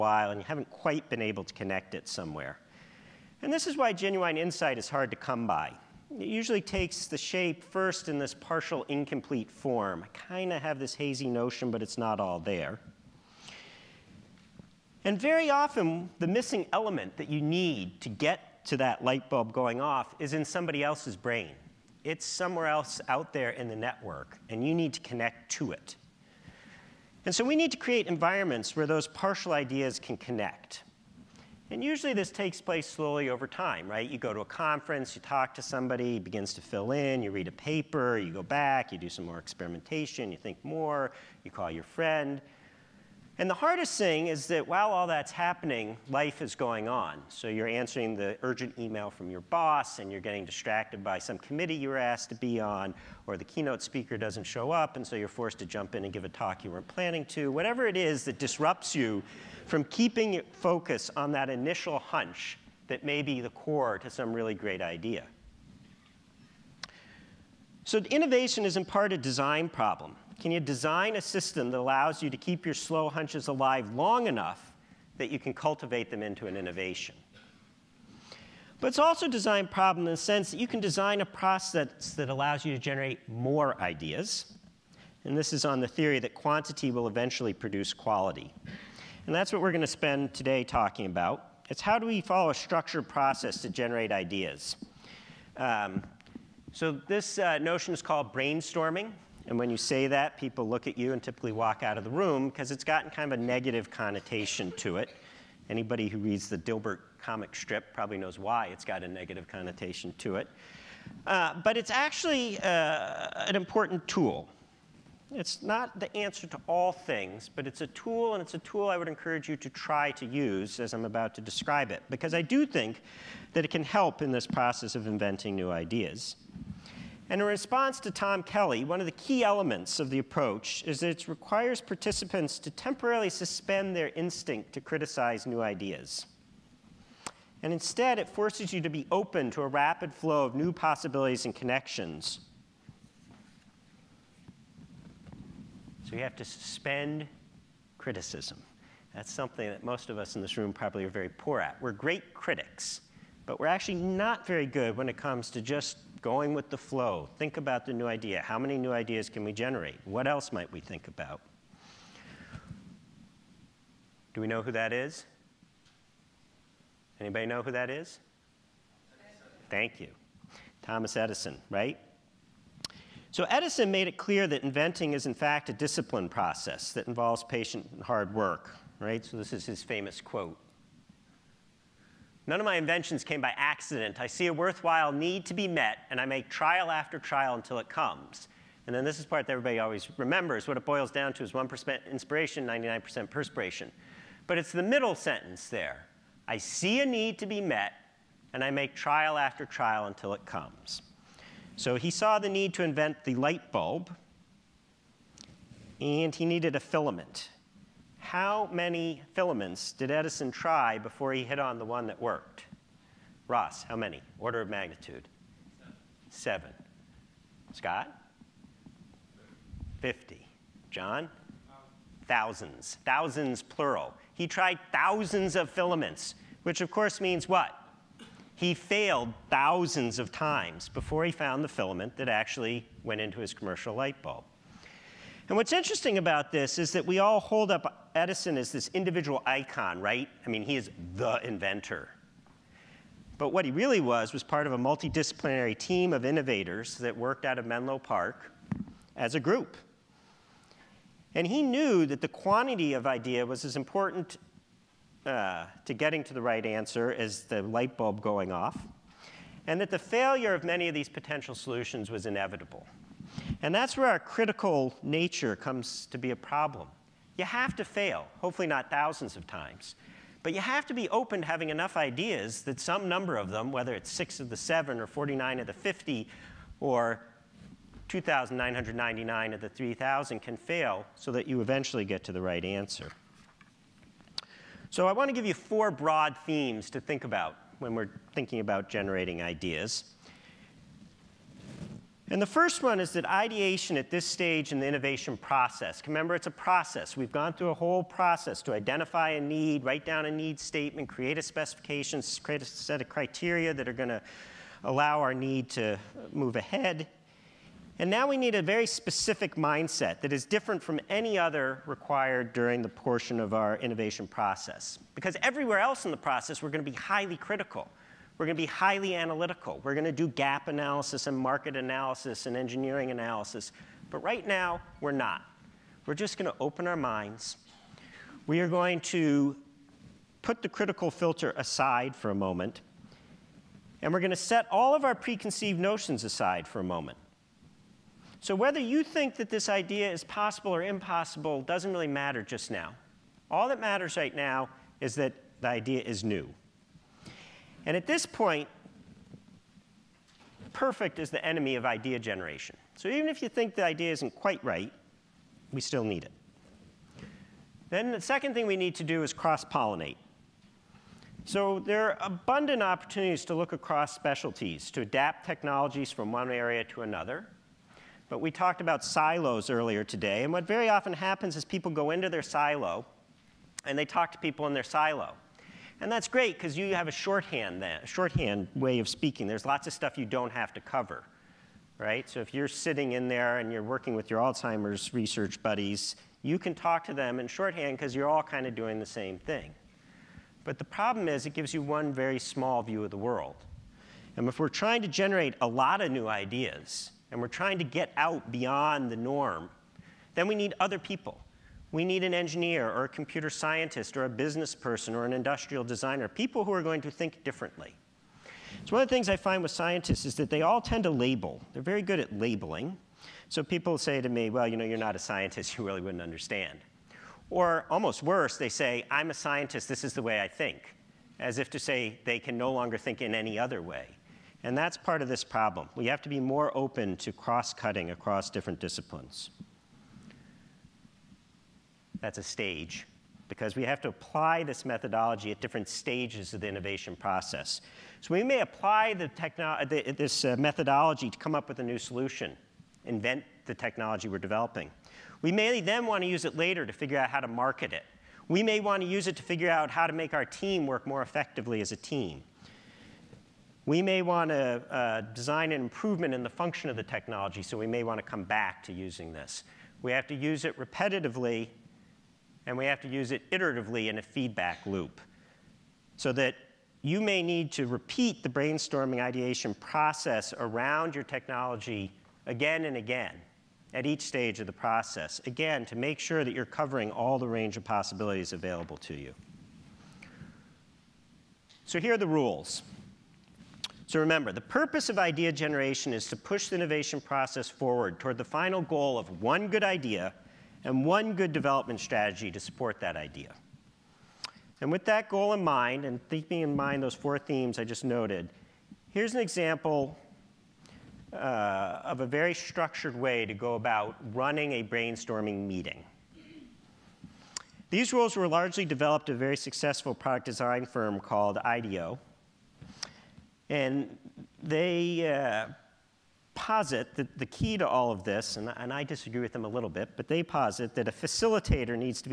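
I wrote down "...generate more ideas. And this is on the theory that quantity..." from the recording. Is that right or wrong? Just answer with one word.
right.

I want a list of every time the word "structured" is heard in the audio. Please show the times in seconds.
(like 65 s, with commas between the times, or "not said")
92 s, 502 s.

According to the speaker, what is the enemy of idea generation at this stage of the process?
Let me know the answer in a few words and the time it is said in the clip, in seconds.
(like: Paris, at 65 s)
perfect, at 350 s.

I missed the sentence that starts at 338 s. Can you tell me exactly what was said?
So whether you think that this idea is possible or impossible doesn't really matter just now.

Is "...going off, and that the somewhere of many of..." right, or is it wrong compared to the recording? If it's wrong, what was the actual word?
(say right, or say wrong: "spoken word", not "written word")
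wrong: "failure", not "somewhere".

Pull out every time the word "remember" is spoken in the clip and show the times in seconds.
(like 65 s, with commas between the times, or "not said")
190 s, 296 s, 484 s.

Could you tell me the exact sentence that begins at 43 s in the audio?
And the hardest thing is that while all that's happening, life is going on.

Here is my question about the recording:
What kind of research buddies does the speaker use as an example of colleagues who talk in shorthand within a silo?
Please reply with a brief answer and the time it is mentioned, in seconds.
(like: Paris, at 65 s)
Alzheimer's, at 384 s.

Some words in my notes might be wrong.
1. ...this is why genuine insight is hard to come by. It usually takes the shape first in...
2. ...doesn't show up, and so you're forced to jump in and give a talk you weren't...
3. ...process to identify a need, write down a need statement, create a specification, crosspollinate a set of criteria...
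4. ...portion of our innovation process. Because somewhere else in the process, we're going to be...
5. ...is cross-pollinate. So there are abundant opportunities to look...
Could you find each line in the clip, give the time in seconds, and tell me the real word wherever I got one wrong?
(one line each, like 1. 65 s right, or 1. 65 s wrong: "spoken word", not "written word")
1. 3 s right
2. 54 s right
3. 298 s wrong: "create", not "crosspollinate"
4. 312 s wrong: "everywhere", not "somewhere"
5. 359 s right.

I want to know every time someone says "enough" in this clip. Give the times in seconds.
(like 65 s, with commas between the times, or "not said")
74 s, 271 s.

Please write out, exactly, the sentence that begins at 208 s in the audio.
How many filaments did Edison try before he hit on the one that worked?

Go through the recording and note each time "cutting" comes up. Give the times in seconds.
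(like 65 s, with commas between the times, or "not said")
427 s.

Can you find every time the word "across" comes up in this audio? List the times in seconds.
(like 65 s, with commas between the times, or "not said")
363 s, 428 s.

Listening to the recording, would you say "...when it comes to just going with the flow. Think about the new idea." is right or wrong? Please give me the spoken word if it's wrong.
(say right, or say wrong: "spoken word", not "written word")
right.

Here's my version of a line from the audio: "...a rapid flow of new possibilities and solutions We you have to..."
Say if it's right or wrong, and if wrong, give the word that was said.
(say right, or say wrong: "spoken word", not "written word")
wrong: "connections", not "solutions".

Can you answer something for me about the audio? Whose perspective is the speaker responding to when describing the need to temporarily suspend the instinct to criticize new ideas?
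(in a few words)
Tom Kelley.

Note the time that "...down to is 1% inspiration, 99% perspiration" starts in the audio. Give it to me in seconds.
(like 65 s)
191 s.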